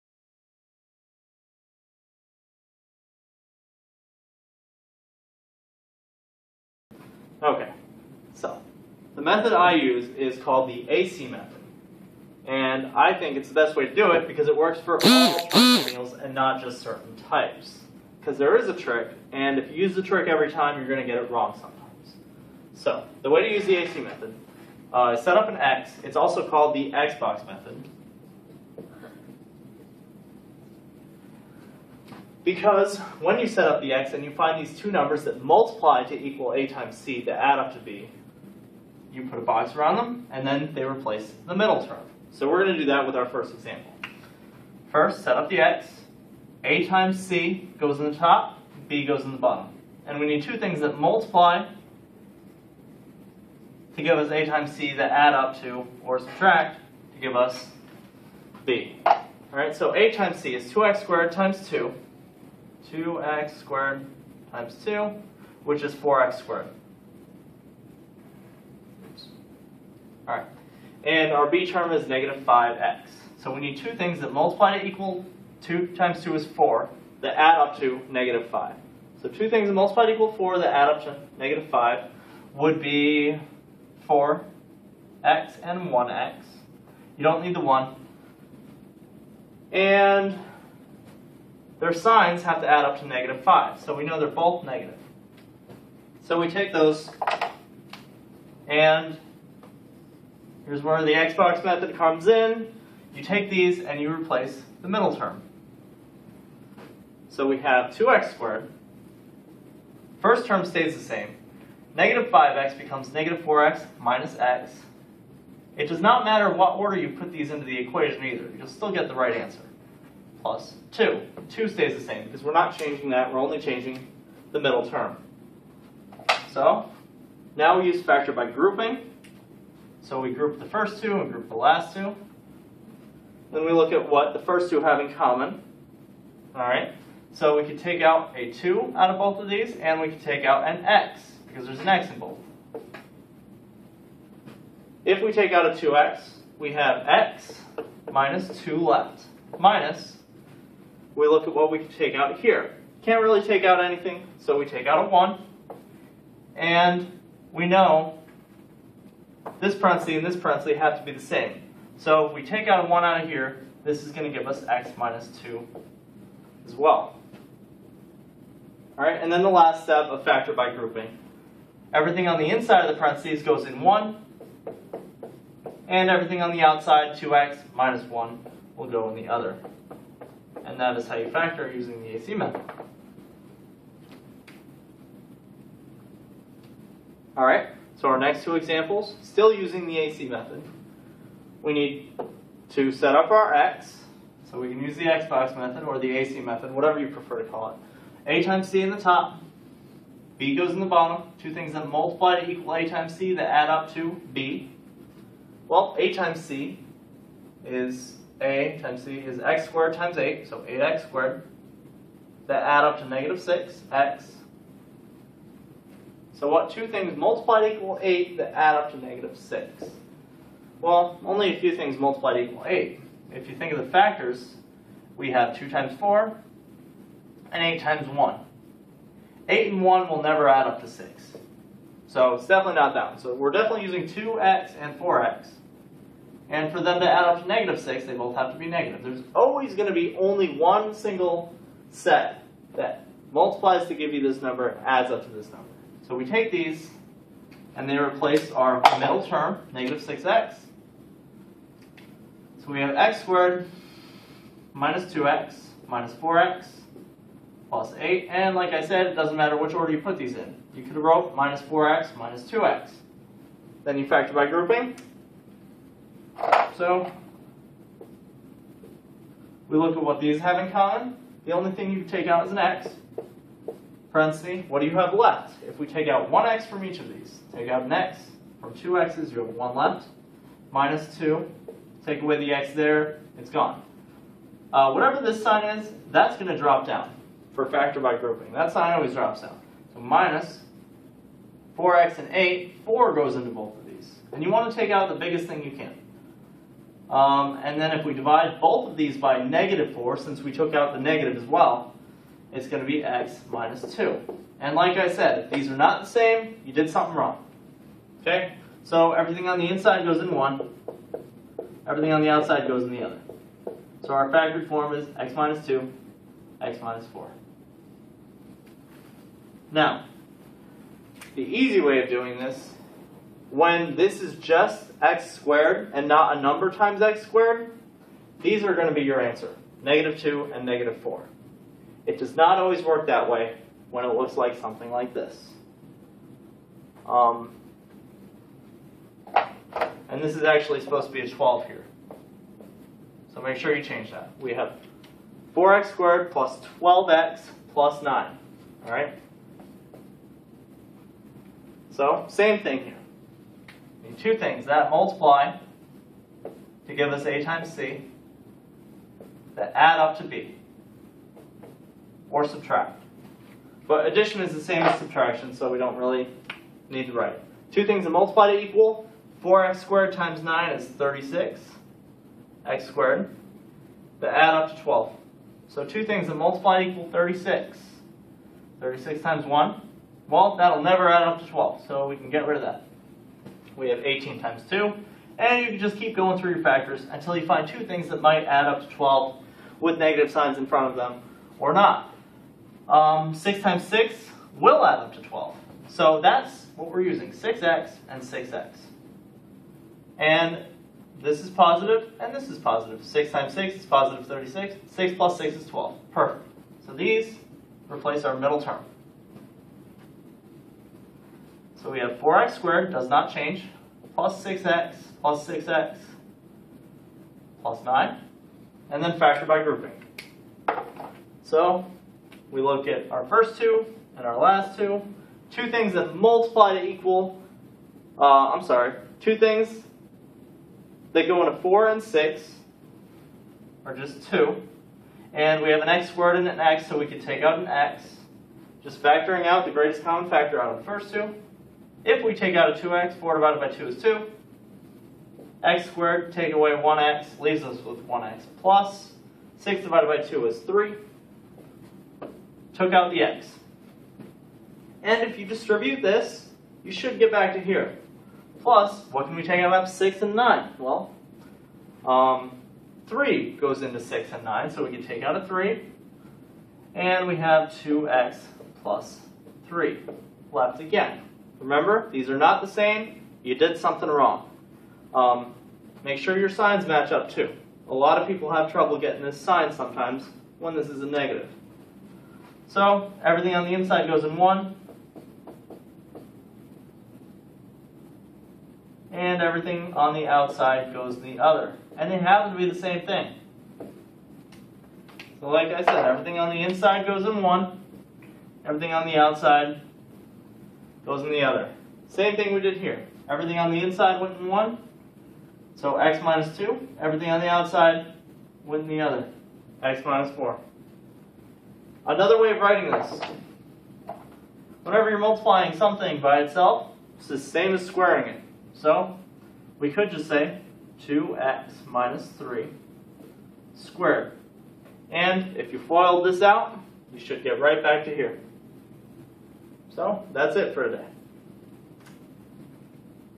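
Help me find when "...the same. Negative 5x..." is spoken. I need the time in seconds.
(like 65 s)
110 s.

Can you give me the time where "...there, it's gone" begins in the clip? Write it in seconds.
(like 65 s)
282 s.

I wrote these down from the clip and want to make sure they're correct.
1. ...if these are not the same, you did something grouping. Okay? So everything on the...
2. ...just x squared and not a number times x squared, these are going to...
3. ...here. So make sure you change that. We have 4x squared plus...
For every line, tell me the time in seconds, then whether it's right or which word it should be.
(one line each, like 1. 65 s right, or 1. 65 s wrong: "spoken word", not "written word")
1. 305 s wrong: "wrong", not "grouping"
2. 324 s right
3. 341 s right.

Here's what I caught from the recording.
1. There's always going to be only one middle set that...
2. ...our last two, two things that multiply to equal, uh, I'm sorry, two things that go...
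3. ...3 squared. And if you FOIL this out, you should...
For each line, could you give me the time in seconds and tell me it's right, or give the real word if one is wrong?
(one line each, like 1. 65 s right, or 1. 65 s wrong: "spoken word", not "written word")
1. 239 s wrong: "single", not "middle"
2. 424 s right
3. 522 s right.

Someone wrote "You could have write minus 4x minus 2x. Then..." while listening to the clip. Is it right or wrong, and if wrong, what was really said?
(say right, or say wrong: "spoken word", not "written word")
wrong: "wrote", not "write".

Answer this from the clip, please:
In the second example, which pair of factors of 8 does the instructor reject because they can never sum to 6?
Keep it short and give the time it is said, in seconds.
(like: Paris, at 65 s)
8 and 1, at 229 s.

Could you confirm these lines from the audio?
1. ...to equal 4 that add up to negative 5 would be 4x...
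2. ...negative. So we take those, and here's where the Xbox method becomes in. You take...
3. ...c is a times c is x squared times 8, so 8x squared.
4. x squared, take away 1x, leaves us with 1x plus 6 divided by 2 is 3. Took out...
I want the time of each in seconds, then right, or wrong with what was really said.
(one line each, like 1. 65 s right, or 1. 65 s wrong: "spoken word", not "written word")
1. 80 s right
2. 94 s wrong: "comes", not "becomes"
3. 206 s right
4. 445 s right.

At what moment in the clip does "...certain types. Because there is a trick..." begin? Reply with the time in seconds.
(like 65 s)
16 s.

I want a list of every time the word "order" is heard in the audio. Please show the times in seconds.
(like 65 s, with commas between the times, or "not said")
116 s, 259 s.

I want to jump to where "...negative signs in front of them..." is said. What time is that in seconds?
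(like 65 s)
389 s.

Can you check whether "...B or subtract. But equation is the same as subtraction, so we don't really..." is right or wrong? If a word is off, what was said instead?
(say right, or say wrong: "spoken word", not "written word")
wrong: "addition", not "equation".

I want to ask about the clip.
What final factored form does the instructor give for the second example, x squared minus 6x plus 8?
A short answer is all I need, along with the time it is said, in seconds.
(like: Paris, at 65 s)
x minus 2, x minus 4, at 315 s.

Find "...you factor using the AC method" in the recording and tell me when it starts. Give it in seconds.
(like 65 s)
181 s.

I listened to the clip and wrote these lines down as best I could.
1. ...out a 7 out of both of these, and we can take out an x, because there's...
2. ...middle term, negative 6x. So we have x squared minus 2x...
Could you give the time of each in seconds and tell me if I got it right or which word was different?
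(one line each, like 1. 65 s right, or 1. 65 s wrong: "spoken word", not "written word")
1. 138 s wrong: "2", not "7"
2. 248 s right.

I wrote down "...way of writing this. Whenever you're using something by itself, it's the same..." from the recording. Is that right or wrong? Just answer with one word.
wrong.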